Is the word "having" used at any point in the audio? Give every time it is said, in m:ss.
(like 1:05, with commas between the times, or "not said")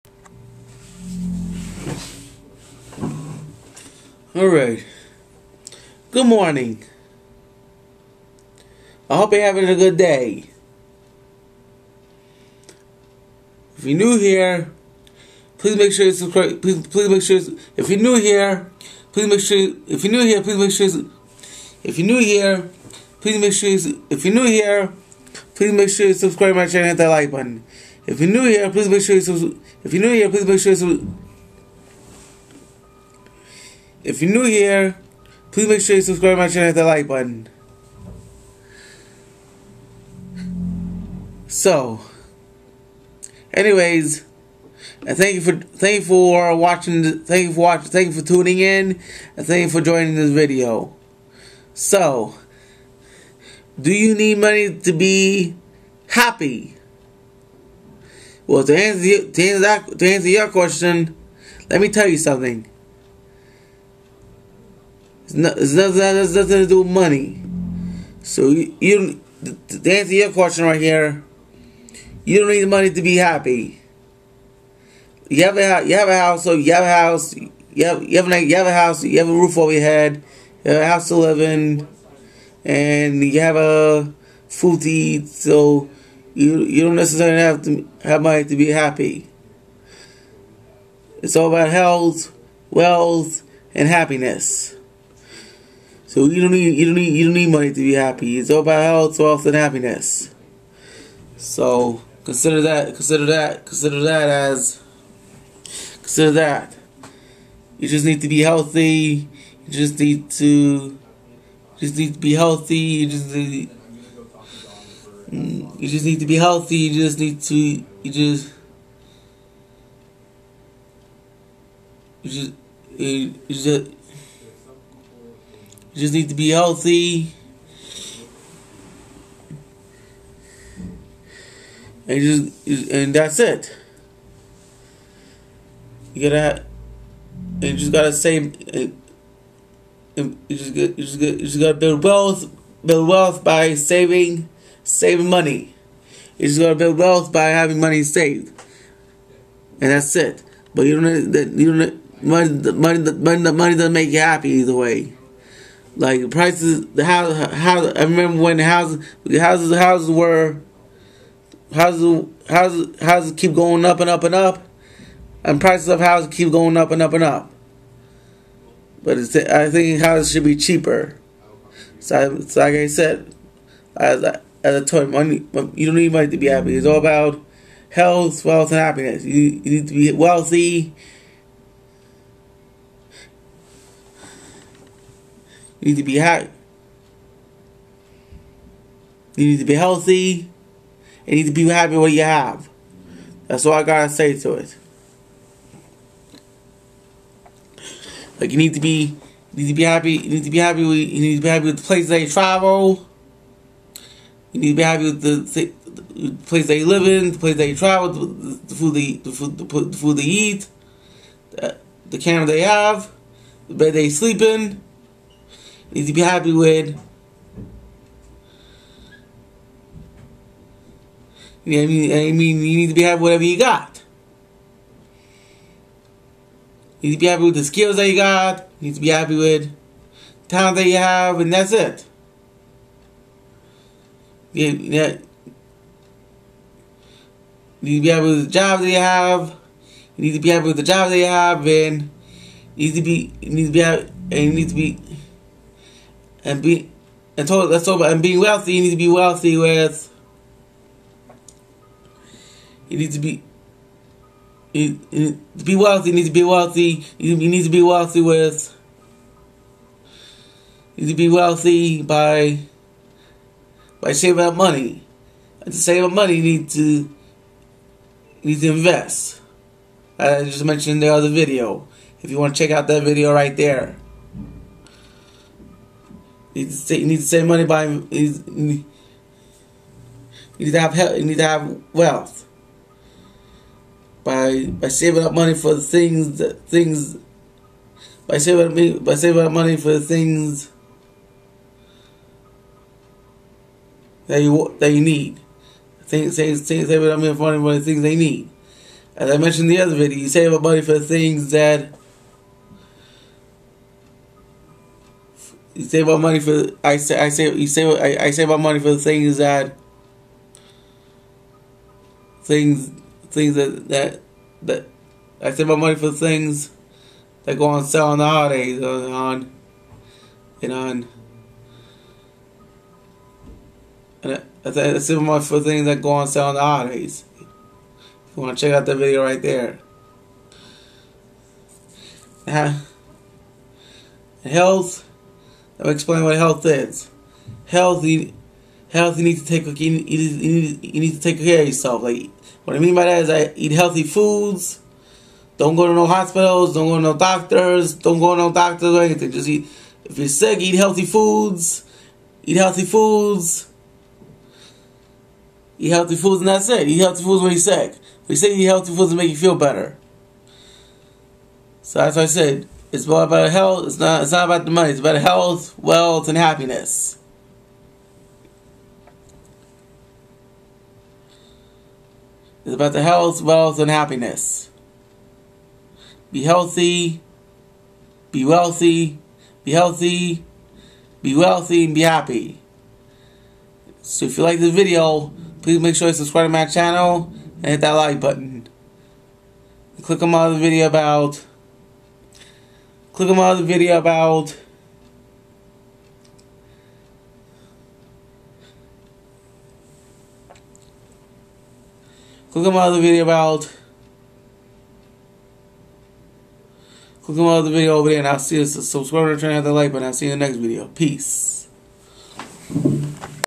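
0:09, 2:27.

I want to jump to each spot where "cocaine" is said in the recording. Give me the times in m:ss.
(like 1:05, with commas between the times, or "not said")
not said.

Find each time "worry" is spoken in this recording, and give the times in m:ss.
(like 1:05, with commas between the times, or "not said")
not said.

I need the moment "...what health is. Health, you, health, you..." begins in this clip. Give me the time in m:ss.
5:36.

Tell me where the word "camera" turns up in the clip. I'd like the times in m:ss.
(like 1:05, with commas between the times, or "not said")
3:32.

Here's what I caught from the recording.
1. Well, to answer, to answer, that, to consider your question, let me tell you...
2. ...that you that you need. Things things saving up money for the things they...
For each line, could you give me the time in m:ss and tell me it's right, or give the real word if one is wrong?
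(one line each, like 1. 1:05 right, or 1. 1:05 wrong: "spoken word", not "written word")
1. 0:58 wrong: "answer", not "consider"
2. 4:54 right.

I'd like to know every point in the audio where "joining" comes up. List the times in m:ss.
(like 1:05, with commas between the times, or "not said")
0:49.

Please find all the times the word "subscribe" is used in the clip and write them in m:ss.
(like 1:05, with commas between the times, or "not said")
0:16, 0:26, 0:36, 6:26, 6:48.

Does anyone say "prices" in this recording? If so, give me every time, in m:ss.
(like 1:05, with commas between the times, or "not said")
2:36, 2:45.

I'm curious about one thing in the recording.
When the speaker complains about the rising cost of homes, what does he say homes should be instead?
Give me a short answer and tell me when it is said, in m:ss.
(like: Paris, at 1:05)
cheaper, at 2:50.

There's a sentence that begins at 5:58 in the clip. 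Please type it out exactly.
We say eat healthy foods to make you feel better.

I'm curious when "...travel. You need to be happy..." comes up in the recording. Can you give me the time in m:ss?
3:22.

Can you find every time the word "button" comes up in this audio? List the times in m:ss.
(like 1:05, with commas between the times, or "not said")
0:27, 0:37, 6:28, 6:49.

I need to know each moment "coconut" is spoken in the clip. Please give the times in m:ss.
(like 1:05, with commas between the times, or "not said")
not said.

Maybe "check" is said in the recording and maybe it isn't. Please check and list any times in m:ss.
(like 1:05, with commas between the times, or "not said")
4:32, 5:28.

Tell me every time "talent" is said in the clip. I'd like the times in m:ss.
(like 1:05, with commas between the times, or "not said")
3:50.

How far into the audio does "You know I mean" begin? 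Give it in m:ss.
3:41.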